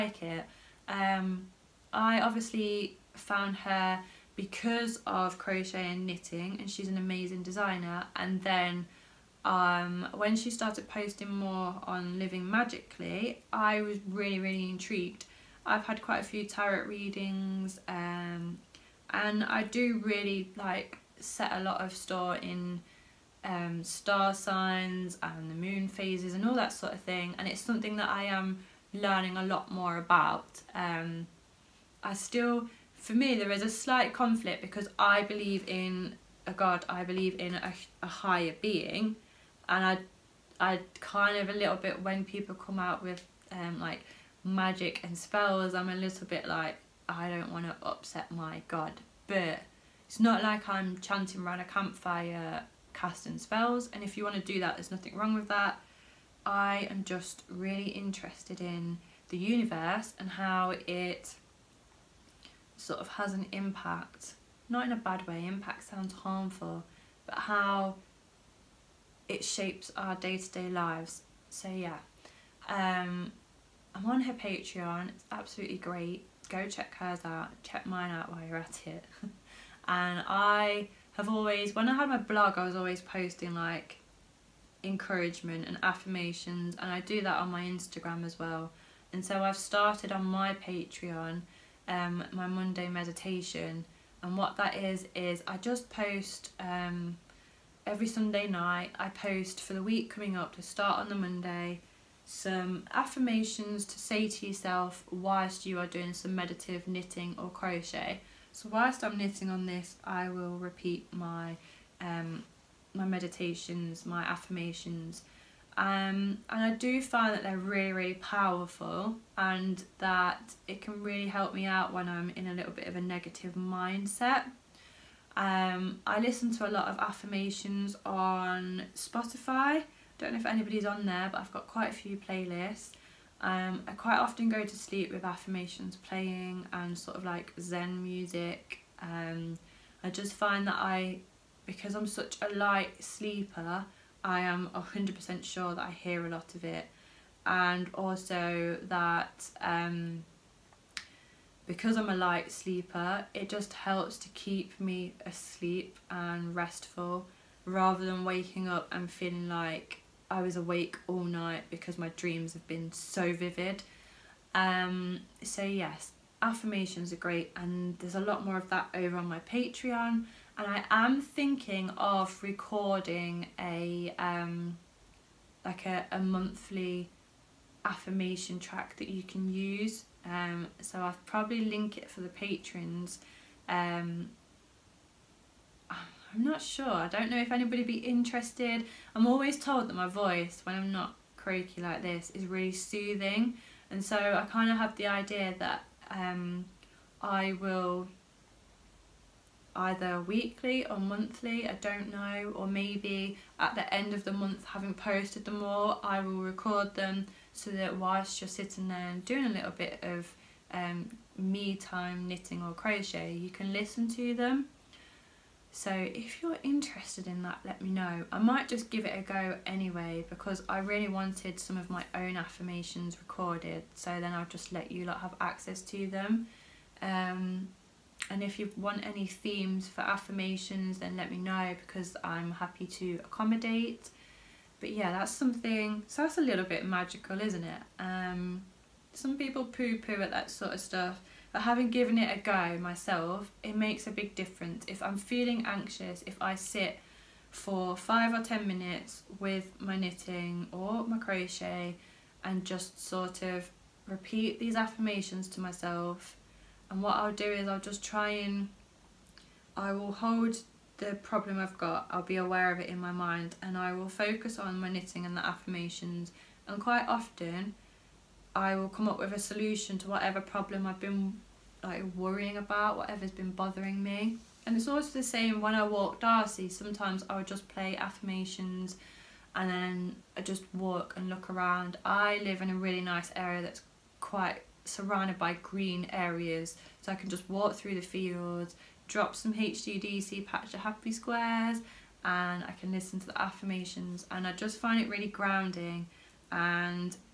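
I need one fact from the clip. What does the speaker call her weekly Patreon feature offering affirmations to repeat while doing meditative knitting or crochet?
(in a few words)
Monday Meditation.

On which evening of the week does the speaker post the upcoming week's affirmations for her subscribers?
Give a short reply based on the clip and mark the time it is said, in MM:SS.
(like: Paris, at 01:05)
Sunday night, at 01:38.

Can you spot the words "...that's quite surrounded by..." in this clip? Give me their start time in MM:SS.
04:43.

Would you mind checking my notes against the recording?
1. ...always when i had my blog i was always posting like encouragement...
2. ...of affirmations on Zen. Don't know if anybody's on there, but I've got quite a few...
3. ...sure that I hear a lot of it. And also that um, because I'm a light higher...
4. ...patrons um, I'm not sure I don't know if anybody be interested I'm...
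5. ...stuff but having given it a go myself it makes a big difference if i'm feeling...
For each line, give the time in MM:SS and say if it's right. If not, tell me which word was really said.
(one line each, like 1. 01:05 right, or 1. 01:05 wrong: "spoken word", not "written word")
1. 01:21 right
2. 02:06 wrong: "Spotify", not "Zen"
3. 02:25 wrong: "sleeper", not "higher"
4. 03:02 right
5. 04:00 right.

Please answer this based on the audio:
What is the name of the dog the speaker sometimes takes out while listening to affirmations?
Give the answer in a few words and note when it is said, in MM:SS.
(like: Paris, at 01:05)
Darcy, at 04:36.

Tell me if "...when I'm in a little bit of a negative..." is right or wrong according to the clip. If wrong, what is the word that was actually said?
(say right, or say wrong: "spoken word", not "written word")
right.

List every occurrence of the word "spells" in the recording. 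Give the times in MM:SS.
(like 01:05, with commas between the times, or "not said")
00:45, 00:53.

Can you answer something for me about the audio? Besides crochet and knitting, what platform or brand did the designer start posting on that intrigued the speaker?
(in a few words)
Living Magically.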